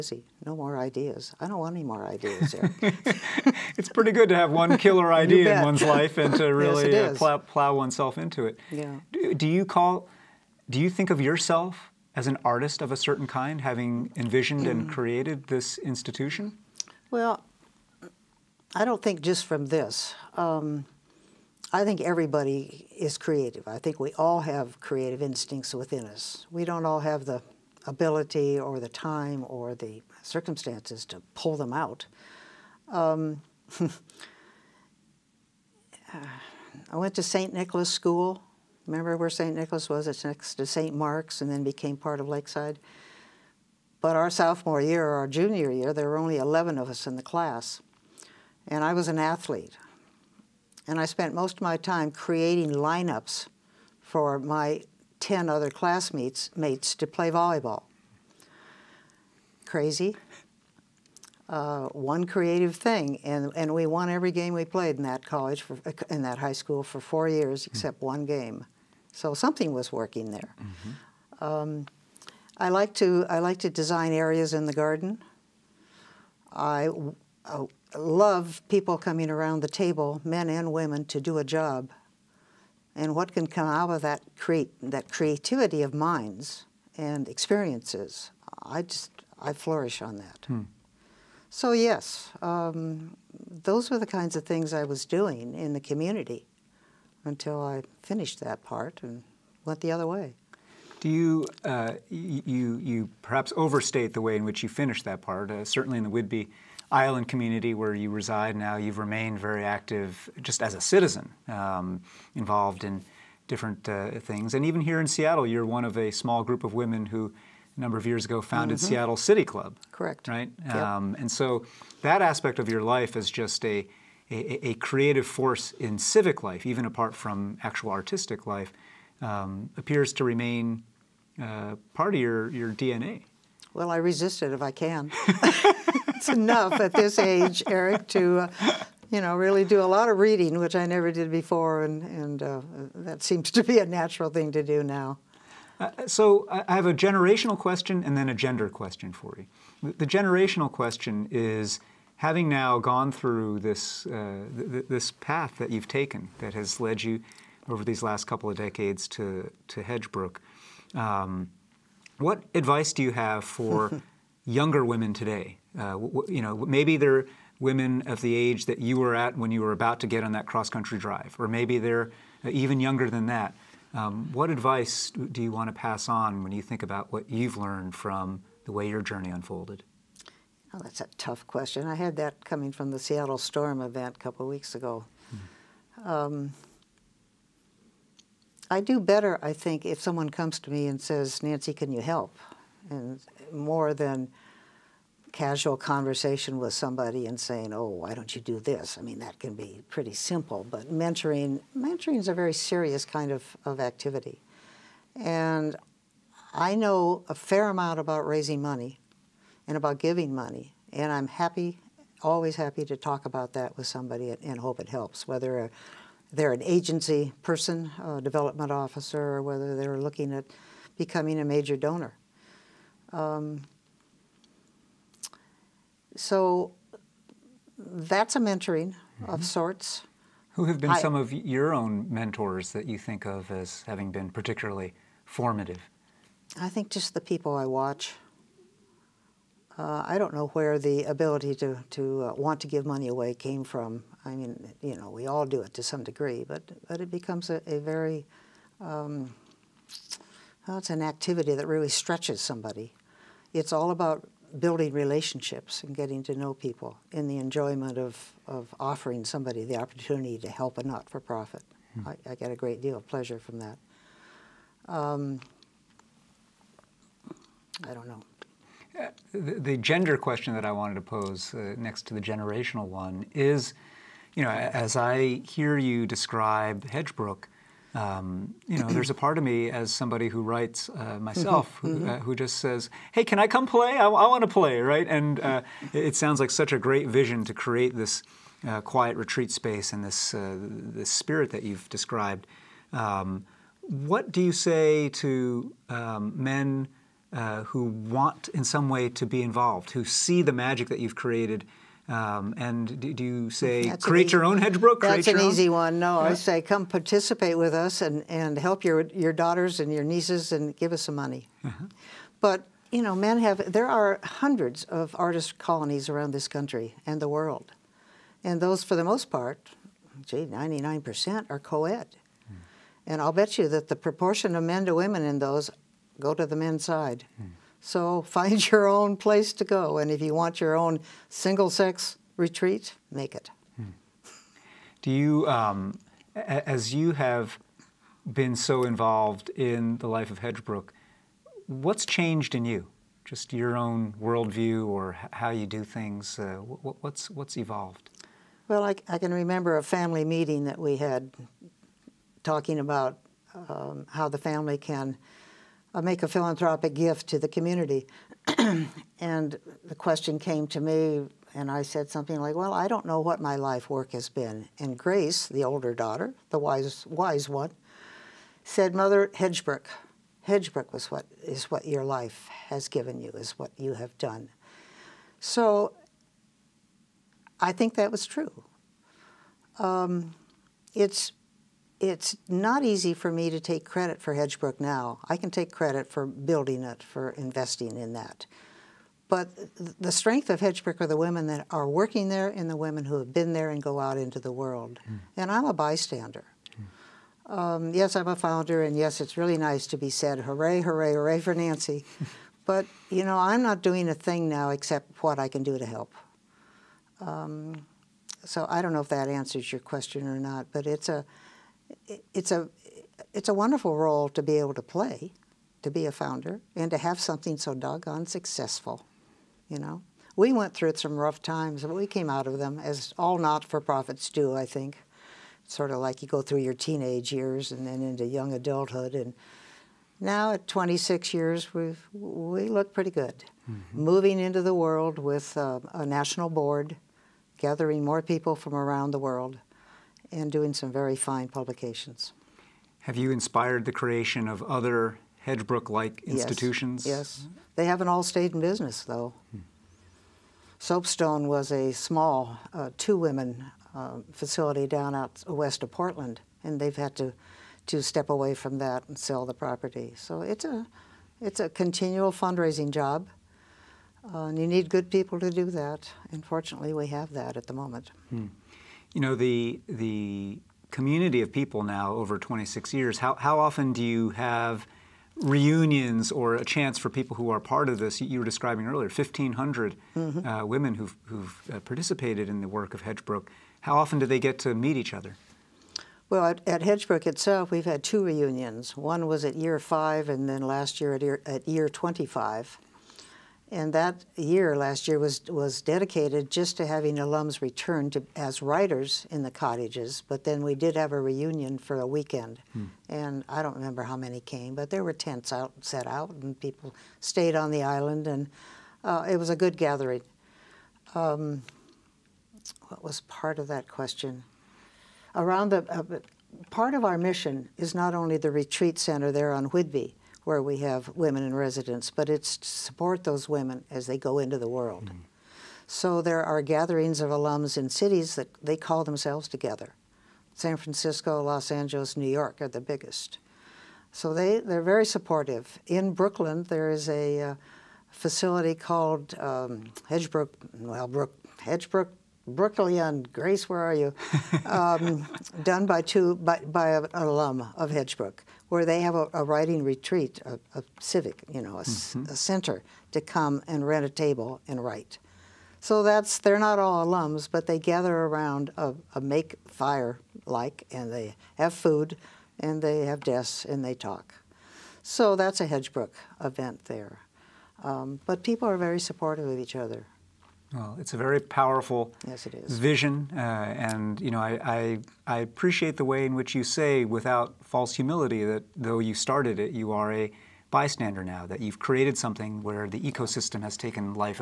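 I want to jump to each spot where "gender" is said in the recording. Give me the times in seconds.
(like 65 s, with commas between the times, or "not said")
148 s, 269 s.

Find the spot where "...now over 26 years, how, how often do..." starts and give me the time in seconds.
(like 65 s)
471 s.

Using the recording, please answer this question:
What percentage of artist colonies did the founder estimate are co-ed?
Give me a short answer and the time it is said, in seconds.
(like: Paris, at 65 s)
99%, at 320 s.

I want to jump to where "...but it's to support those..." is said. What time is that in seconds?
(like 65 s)
522 s.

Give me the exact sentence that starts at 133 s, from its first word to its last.
Well, I resist it if I can.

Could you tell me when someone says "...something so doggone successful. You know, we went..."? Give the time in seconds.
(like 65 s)
417 s.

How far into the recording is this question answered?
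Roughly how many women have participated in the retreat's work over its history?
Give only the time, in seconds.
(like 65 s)
479 s.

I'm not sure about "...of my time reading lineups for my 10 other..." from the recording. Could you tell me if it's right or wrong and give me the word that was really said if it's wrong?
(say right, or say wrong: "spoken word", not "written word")
wrong: "creating", not "reading".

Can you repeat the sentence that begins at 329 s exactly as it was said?
And if you want your own single sex retreat, make it.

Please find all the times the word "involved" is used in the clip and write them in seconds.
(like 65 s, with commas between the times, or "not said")
112 s, 299 s, 338 s.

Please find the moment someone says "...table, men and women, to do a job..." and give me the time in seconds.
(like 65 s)
79 s.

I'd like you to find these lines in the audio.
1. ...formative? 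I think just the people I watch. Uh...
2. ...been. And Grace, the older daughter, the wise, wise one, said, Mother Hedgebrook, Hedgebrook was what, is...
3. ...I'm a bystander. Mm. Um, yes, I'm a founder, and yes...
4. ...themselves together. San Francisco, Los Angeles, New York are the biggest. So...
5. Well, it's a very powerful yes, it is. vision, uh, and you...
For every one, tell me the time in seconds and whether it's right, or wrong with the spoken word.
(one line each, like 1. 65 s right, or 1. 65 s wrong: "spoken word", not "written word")
1. 235 s right
2. 364 s right
3. 395 s right
4. 529 s right
5. 570 s right.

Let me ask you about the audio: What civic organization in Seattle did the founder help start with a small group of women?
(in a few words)
Seattle City Club.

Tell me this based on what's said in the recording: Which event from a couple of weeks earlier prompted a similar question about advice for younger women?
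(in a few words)
Seattle Storm event.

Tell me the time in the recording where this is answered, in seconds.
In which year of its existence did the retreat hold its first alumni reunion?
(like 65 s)
489 s.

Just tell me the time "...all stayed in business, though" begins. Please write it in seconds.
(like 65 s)
448 s.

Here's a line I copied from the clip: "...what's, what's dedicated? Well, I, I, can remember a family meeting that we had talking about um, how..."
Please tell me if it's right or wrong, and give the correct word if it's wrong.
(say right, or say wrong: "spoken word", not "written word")
wrong: "evolved", not "dedicated".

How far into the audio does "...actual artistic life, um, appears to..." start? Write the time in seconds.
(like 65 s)
127 s.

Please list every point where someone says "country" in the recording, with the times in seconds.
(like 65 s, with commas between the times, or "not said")
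170 s, 316 s.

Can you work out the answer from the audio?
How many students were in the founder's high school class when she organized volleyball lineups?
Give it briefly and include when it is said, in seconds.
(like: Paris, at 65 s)
11, at 46 s.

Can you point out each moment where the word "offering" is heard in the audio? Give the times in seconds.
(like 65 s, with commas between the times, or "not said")
258 s.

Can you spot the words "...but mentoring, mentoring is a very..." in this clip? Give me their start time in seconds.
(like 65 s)
200 s.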